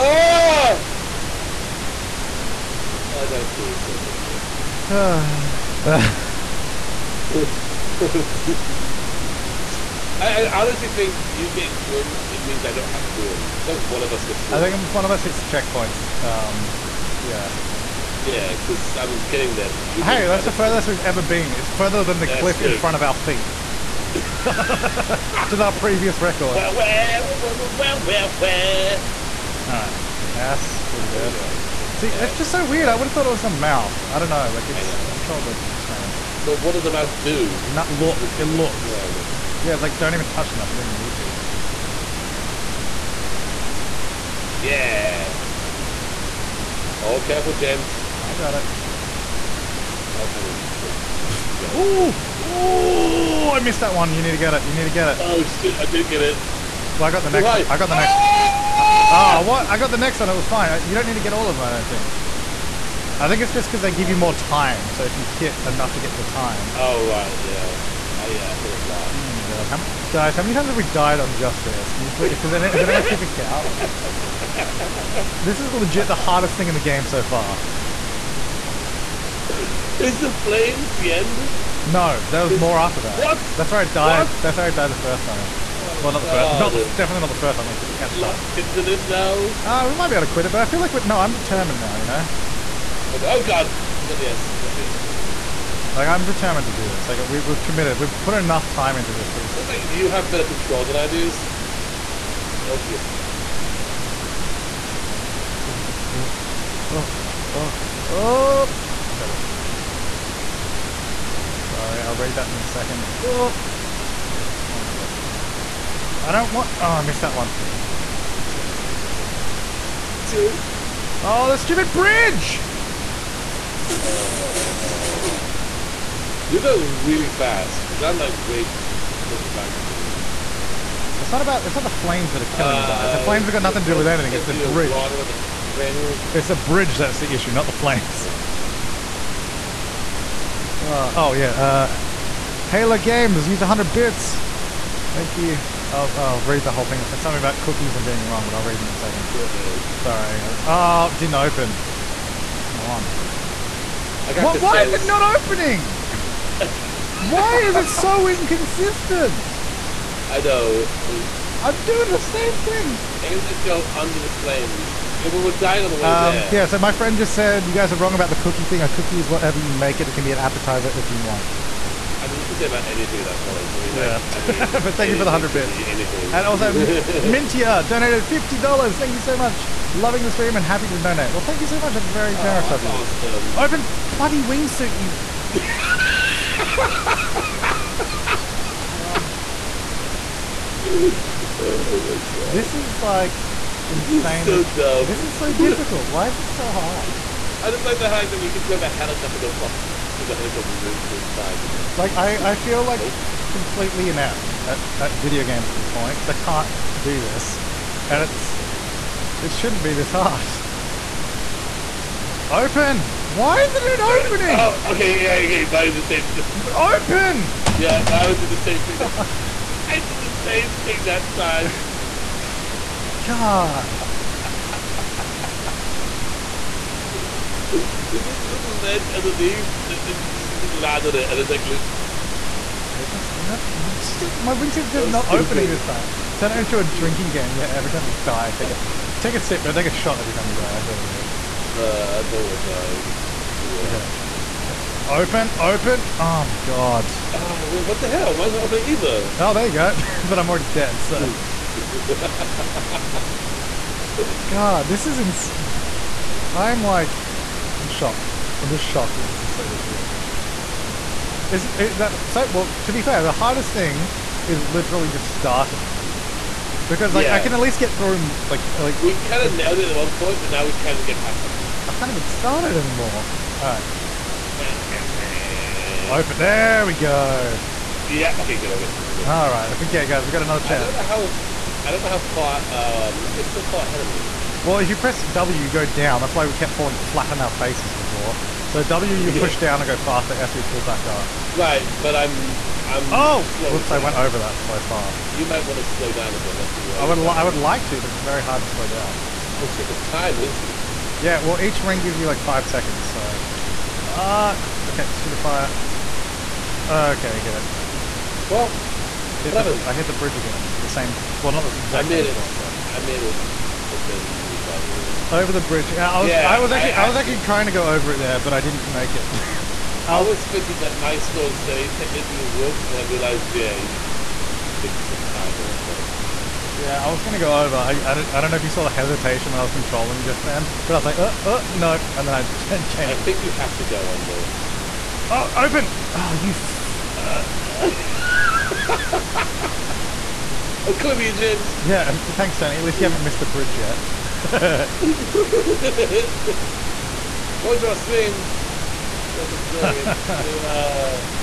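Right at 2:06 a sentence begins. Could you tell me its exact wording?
You go really fast, because I'm like way further back than you.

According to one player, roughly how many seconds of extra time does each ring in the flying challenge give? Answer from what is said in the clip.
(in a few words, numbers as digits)
5.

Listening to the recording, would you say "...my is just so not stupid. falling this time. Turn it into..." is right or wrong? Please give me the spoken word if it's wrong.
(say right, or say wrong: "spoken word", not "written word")
wrong: "opening", not "falling".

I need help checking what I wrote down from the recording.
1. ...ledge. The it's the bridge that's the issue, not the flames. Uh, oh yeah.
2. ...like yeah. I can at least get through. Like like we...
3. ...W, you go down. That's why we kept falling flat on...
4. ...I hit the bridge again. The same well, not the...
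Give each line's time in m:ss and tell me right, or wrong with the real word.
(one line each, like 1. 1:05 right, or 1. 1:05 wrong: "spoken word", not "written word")
1. 2:14 wrong: "bridge", not "ledge"
2. 4:27 right
3. 4:45 right
4. 5:09 right.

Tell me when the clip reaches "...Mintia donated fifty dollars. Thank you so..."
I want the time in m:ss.
2:56.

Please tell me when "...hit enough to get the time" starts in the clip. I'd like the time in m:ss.
1:05.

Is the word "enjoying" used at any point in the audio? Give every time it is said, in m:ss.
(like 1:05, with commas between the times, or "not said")
5:49.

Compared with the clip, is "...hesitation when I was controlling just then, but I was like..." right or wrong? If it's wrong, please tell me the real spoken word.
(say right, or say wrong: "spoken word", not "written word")
right.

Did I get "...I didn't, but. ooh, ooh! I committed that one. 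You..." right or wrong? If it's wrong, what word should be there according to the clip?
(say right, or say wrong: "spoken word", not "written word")
wrong: "missed", not "committed".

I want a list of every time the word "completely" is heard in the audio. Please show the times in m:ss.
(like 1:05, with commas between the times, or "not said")
3:23.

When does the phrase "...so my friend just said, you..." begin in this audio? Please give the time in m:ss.
2:46.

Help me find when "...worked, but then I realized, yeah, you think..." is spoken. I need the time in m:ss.
5:22.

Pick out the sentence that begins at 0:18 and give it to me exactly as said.
Yeah, because I'm getting there, but you.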